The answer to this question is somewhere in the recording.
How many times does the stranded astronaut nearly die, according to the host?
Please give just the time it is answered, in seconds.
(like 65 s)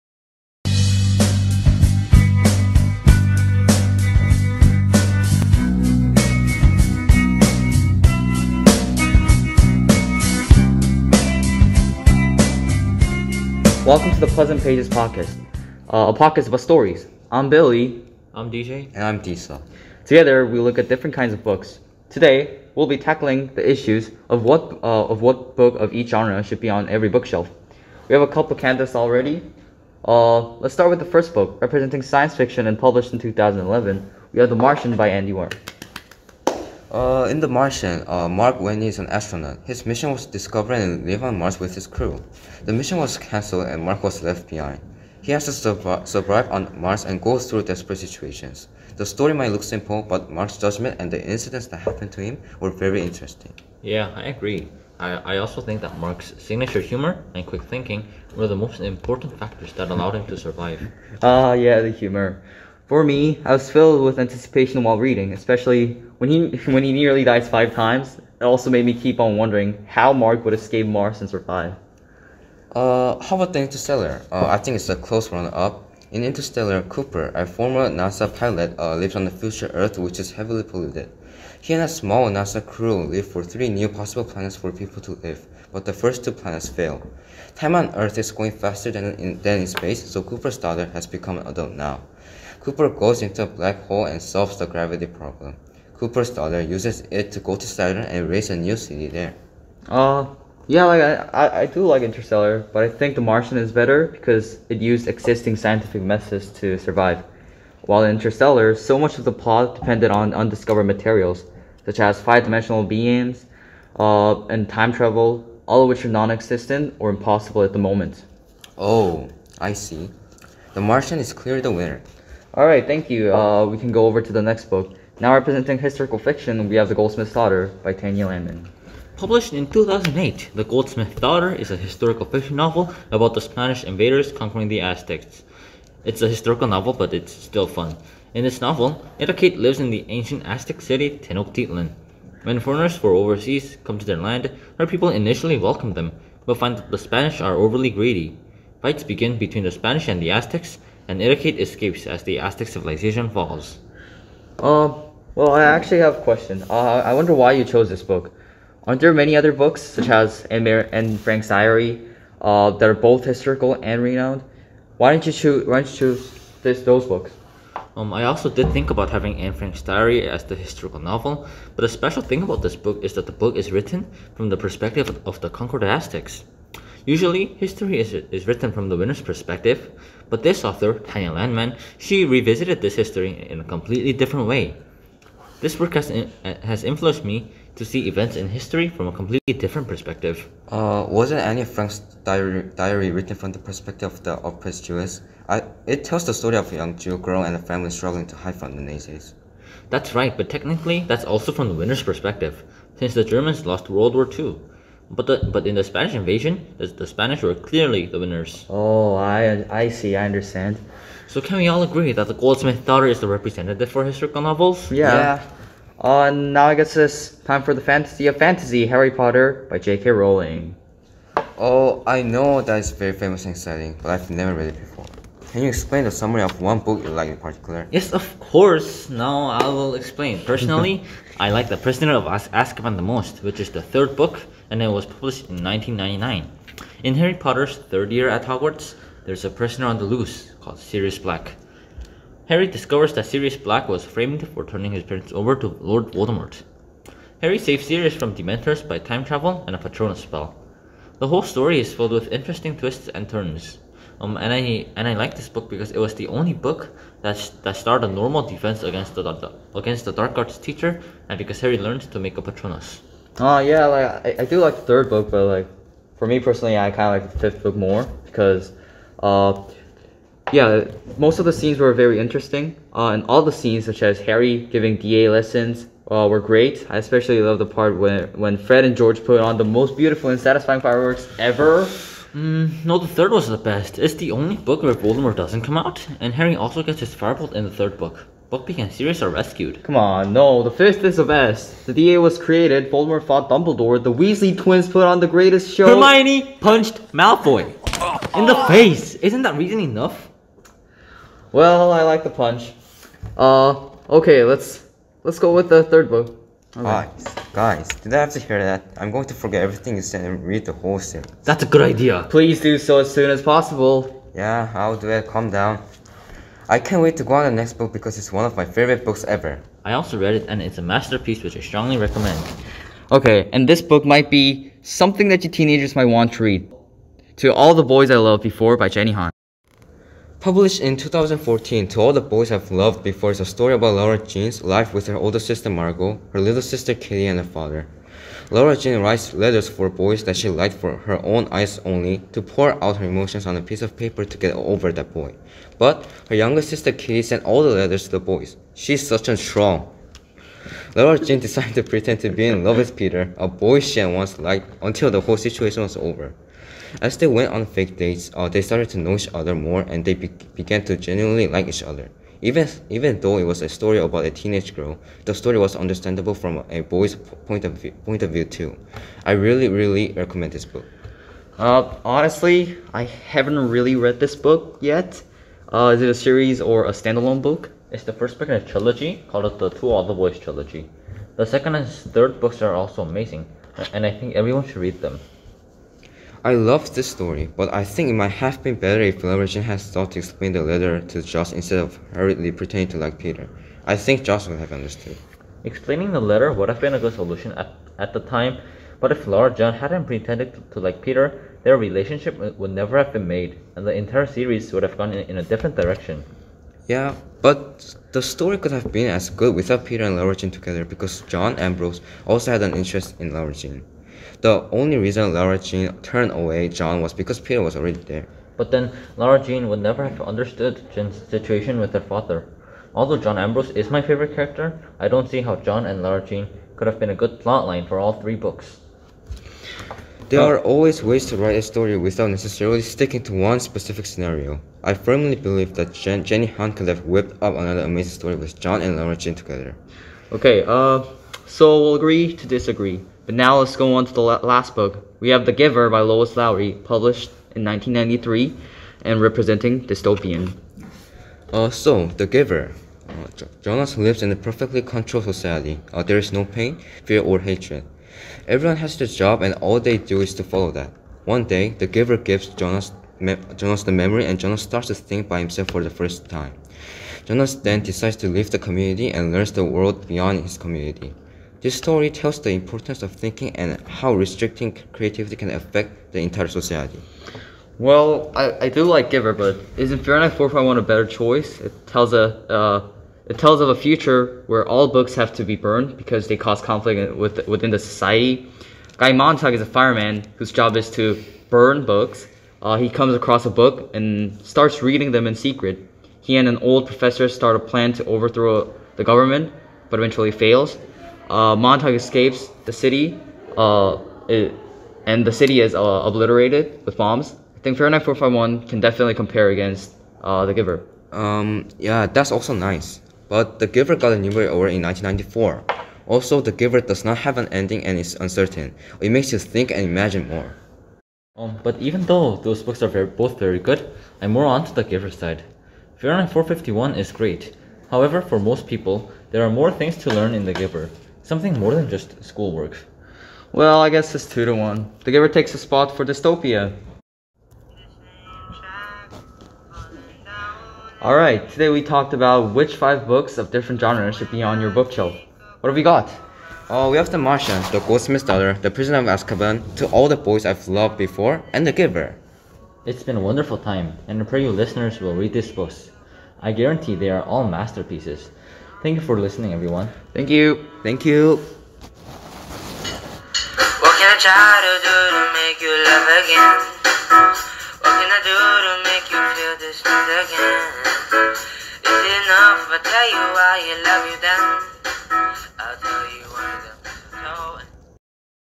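67 s.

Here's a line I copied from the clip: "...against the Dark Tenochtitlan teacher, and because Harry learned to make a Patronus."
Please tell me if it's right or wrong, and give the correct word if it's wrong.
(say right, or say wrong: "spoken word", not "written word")
wrong: "Arts", not "Tenochtitlan".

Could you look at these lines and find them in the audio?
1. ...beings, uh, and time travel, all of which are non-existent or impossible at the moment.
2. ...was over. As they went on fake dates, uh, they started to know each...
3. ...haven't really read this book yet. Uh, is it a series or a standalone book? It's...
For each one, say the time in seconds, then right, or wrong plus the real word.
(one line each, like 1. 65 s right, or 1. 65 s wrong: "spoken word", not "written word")
1. 112 s right
2. 355 s right
3. 373 s right.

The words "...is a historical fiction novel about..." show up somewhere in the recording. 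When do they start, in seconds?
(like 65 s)
131 s.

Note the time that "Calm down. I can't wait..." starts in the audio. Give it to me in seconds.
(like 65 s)
315 s.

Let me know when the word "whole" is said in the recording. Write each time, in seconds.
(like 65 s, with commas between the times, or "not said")
251 s, 310 s, 355 s.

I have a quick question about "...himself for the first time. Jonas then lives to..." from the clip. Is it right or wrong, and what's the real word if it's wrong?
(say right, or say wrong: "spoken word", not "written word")
wrong: "decides", not "lives".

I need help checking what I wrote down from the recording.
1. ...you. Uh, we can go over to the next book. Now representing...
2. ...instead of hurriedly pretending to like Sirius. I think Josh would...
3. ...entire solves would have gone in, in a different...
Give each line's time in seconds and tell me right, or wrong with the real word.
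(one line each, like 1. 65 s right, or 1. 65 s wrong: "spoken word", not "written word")
1. 123 s right
2. 391 s wrong: "Peter", not "Sirius"
3. 403 s wrong: "series", not "solves".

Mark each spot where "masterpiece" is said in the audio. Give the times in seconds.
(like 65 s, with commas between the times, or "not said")
320 s, 557 s.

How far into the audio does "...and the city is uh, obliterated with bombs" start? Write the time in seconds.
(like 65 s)
505 s.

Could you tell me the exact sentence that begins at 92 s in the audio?
Cooper goes into a black hole and solves the gravity problem.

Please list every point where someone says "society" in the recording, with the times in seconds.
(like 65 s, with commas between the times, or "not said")
455 s, 476 s, 487 s.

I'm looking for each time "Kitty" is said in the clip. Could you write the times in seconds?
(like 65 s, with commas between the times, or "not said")
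336 s, 346 s.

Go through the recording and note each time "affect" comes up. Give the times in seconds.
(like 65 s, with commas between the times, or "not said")
475 s.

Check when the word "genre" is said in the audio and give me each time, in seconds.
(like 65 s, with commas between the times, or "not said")
26 s, 543 s.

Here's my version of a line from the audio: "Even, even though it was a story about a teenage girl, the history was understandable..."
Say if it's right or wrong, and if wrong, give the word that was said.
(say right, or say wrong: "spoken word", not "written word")
wrong: "story", not "history".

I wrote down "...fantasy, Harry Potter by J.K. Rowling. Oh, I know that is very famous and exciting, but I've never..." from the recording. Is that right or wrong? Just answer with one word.
right.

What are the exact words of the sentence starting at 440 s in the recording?
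Okay, uh, so we'll agree to disagree.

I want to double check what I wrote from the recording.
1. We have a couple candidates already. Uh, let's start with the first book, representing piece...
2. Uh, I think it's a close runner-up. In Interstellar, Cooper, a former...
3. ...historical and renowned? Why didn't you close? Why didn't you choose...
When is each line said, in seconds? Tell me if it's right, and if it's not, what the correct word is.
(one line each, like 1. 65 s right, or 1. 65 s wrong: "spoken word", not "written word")
1. 28 s wrong: "science", not "piece"
2. 74 s right
3. 163 s wrong: "choose", not "close".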